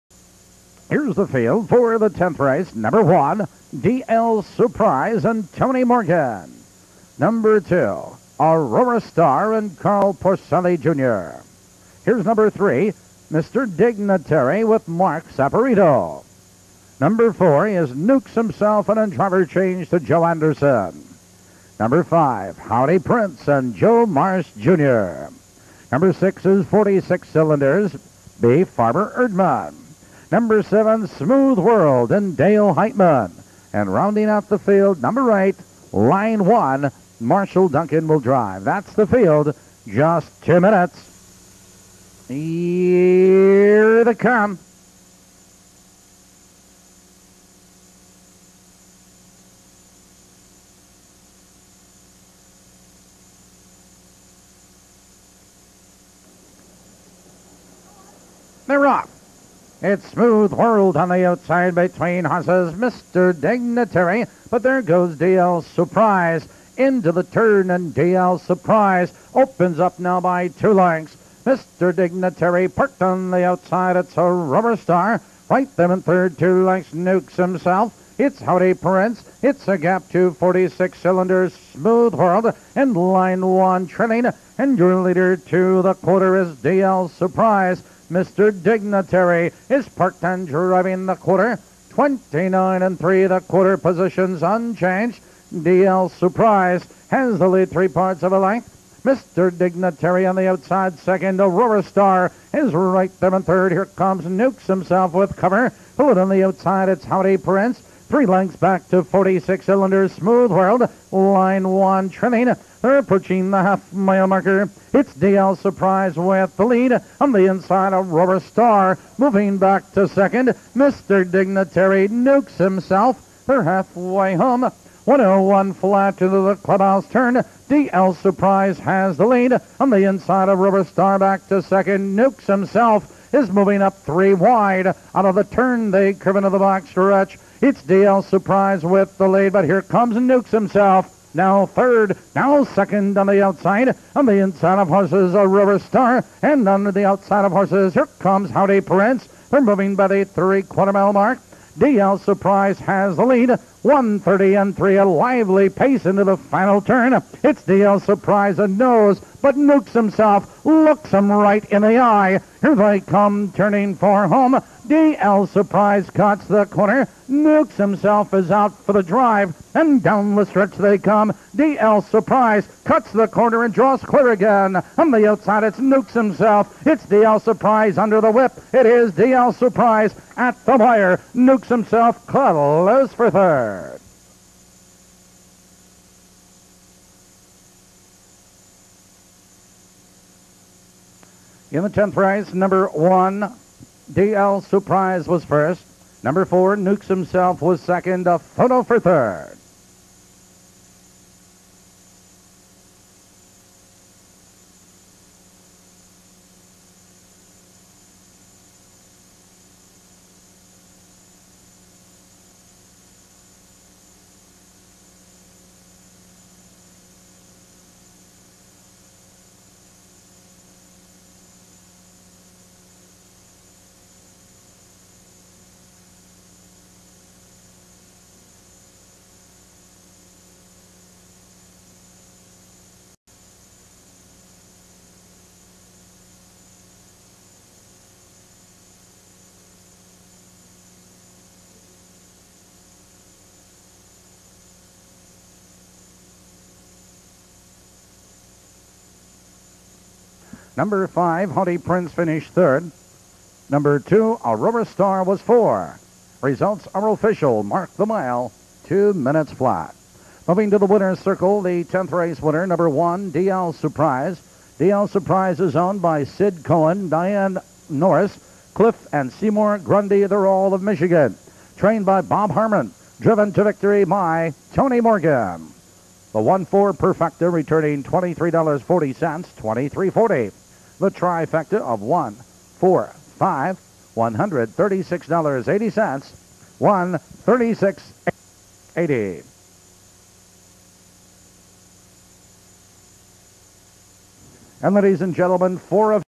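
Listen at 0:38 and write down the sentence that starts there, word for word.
That's the field, just two minutes.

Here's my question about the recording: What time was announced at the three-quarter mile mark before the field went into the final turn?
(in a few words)
130 and 3.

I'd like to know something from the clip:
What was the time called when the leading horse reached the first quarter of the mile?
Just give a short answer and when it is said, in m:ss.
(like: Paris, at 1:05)
29 and 3, at 1:31.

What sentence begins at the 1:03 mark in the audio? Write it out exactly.
Dignitary, but there goes DL Surprise.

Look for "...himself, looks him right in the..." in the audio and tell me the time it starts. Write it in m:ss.
2:39.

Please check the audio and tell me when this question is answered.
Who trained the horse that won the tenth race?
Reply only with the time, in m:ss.
4:32.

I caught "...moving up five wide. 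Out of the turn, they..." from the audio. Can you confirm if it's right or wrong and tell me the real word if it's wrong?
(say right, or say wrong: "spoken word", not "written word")
wrong: "three", not "five".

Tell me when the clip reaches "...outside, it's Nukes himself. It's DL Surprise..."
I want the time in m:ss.
2:55.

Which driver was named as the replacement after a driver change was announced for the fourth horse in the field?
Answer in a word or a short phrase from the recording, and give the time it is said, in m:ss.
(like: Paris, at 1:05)
Joe Anderson, at 0:20.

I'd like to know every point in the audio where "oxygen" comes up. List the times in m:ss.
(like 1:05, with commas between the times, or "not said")
not said.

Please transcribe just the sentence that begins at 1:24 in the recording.
And your leader to the quarter is DL Surprise.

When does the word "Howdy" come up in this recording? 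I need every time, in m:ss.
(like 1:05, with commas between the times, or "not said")
0:22, 1:18, 1:47, 2:28, 4:11.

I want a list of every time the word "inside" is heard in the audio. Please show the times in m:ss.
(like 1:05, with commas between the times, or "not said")
1:57, 2:10, 2:24.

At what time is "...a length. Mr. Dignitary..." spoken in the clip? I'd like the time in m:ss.
1:38.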